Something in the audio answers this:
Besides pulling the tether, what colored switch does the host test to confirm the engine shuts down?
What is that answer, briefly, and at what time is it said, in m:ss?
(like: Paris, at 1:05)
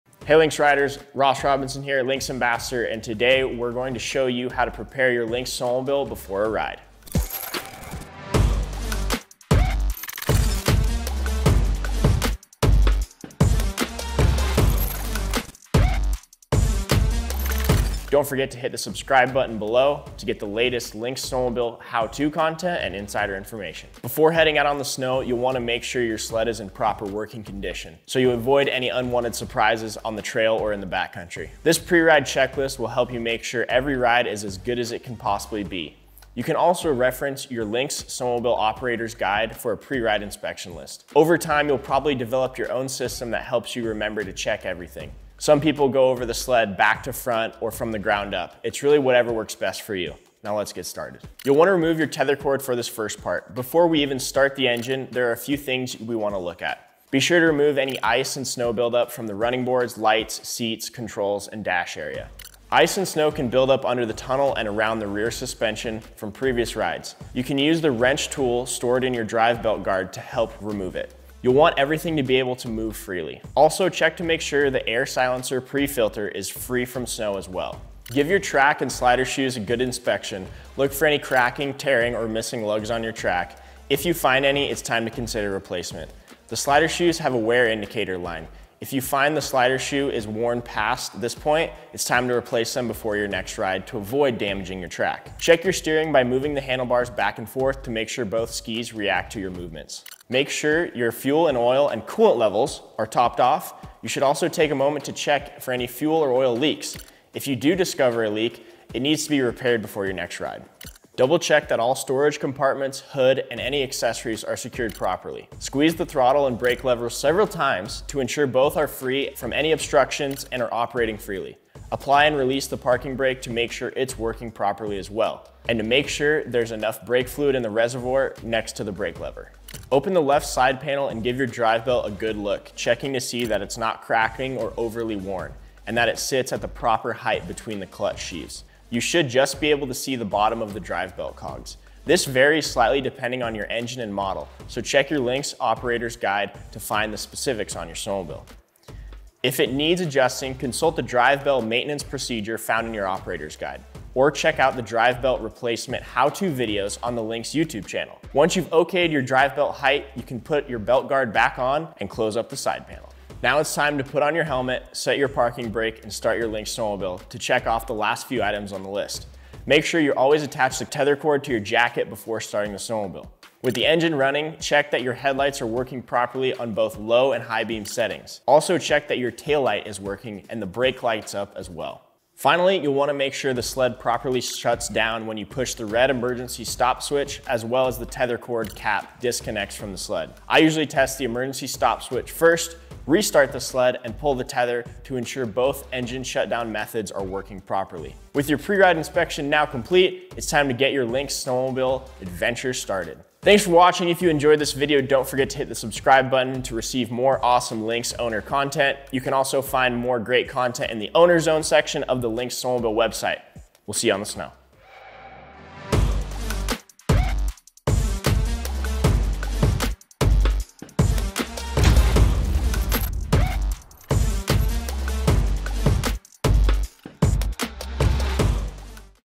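Red emergency stop switch, at 3:05.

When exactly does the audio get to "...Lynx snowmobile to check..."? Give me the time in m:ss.
2:46.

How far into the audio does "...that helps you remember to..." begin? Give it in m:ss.
0:43.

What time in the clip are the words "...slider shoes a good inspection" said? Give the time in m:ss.
1:18.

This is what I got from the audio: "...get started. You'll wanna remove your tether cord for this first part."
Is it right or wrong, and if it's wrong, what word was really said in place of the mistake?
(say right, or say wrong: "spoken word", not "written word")
right.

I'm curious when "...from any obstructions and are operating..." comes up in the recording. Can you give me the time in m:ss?
1:59.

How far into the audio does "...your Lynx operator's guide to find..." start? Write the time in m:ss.
2:25.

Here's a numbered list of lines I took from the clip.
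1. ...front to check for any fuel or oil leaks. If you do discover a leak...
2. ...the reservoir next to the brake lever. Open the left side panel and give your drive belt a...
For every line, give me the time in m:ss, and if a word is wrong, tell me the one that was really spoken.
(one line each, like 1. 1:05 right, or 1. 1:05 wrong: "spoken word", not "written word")
1. 1:44 wrong: "moment", not "front"
2. 2:07 right.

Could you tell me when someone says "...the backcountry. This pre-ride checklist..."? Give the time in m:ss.
0:30.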